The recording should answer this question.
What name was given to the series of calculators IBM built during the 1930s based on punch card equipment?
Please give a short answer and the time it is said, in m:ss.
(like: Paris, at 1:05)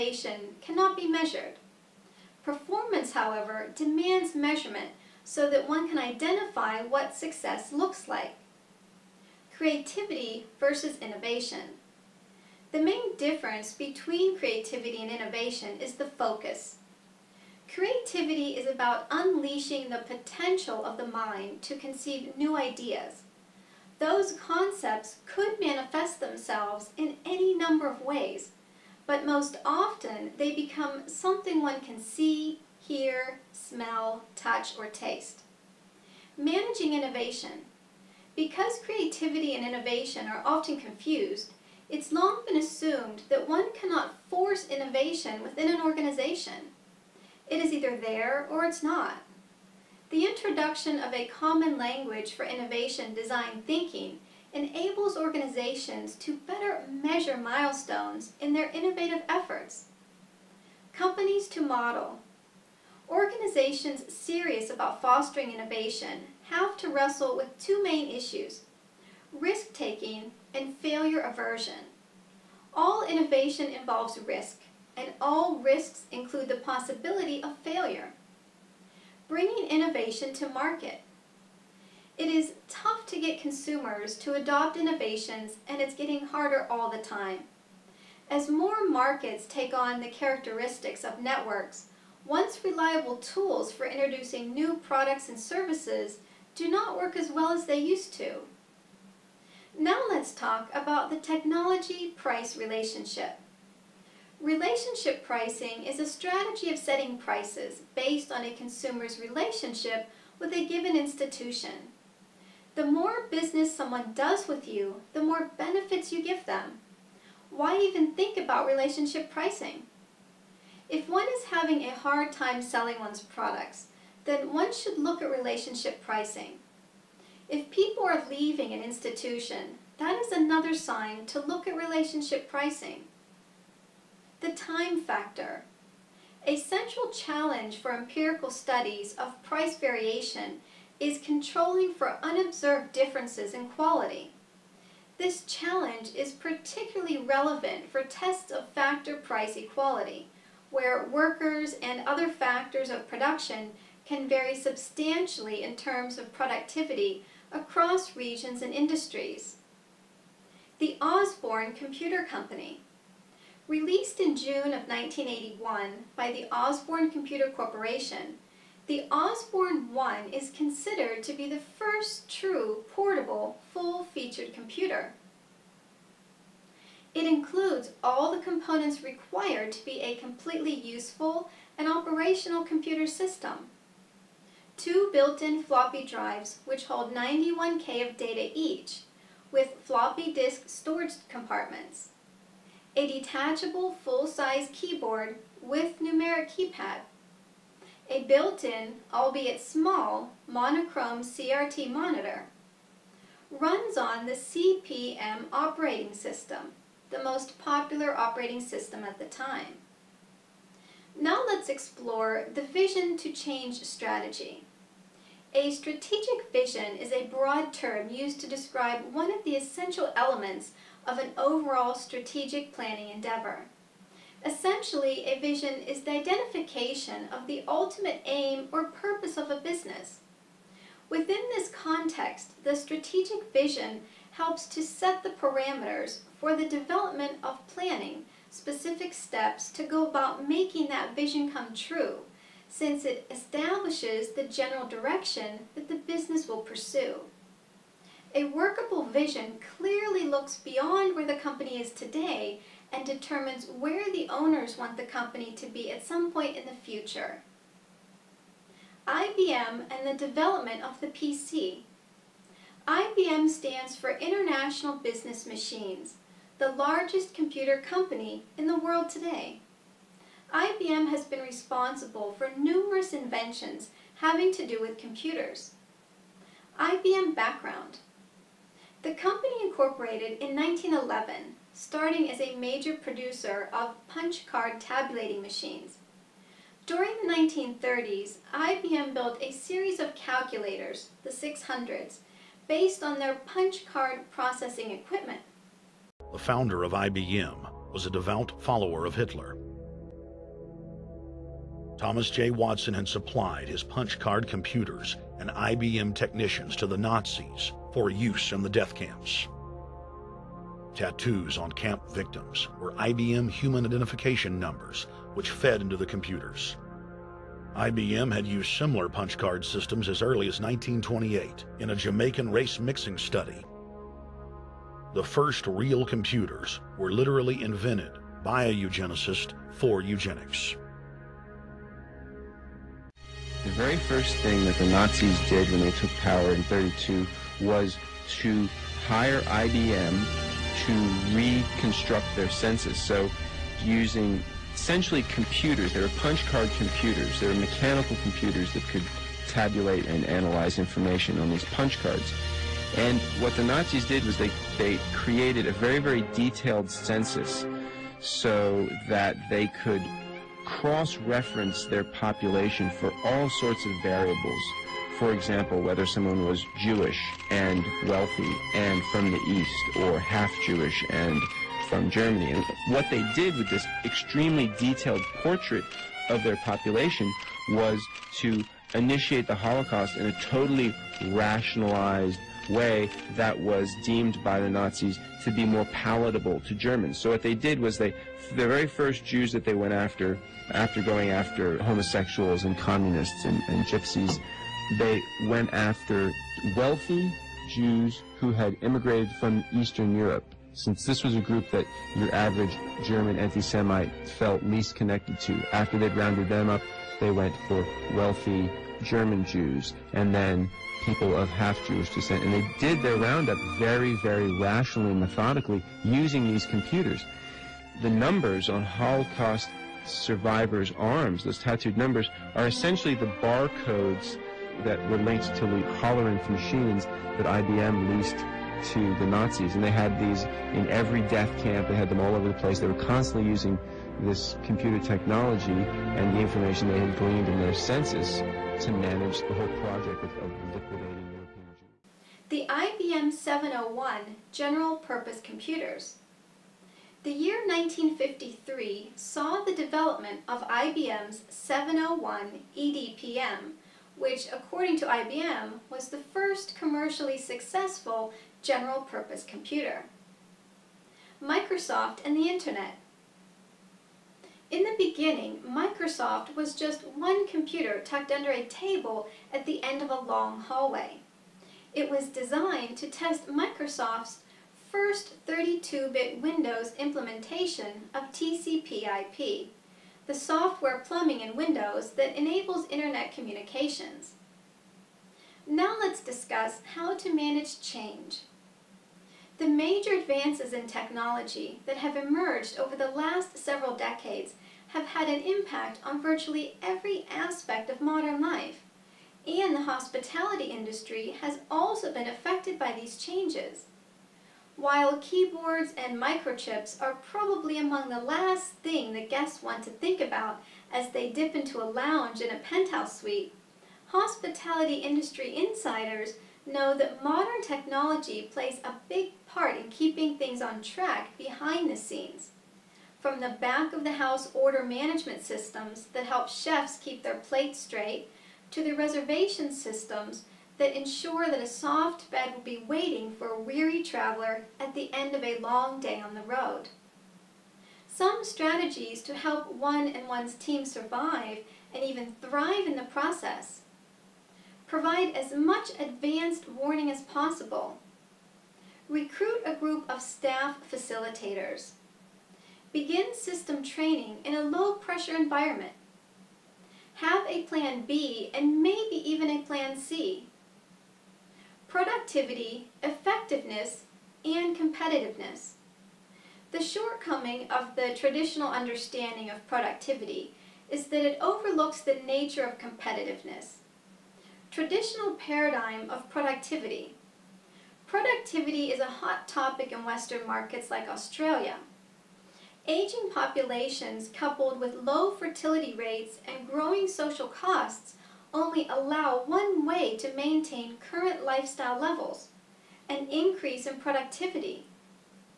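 the 600s, at 4:51.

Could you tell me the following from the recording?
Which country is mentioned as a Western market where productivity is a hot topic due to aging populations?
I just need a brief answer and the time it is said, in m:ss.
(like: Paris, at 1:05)
Australia, at 9:41.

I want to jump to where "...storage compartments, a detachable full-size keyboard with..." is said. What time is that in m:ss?
3:10.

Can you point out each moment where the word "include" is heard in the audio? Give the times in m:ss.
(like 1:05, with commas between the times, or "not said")
1:16, 2:57.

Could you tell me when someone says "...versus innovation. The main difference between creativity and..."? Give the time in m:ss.
0:10.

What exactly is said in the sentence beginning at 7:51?
It was designed to test Microsoft's first 32-bit Windows implementation of TCP/IP, the software plumbing in Windows that enables Internet communications.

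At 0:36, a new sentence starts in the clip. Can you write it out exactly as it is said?
Managing innovation because creativity and innovation are often confused, it's long been assumed that one cannot force innovation within an organization.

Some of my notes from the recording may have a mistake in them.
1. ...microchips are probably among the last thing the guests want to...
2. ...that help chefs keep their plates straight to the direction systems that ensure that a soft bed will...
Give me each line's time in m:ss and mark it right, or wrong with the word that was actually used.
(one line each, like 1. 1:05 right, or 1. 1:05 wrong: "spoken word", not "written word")
1. 8:26 right
2. 8:46 wrong: "reservation", not "direction".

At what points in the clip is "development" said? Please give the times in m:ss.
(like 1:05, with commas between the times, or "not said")
3:56, 4:20, 7:29.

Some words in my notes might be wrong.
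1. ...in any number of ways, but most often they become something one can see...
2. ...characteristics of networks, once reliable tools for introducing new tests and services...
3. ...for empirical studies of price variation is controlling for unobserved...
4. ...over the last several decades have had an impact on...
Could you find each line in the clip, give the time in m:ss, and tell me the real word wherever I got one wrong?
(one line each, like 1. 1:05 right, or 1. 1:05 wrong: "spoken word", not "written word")
1. 0:26 right
2. 1:30 wrong: "products", not "tests"
3. 2:17 right
4. 8:12 right.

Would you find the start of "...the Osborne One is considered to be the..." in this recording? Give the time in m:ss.
2:48.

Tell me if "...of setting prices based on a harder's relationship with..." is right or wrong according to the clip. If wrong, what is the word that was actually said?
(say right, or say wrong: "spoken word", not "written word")
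wrong: "consumer", not "harder".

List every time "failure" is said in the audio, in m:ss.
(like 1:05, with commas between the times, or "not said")
1:10, 1:17.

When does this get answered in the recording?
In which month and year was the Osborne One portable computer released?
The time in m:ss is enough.
2:44.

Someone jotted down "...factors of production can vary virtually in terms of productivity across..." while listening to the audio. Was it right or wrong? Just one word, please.
wrong.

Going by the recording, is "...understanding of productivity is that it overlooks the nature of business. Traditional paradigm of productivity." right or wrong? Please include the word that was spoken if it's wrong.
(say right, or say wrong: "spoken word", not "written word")
wrong: "competitiveness", not "business".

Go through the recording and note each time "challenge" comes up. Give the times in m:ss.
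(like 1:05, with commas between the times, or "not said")
2:17, 2:25.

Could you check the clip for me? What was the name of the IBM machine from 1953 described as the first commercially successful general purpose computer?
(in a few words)
701 EDPM.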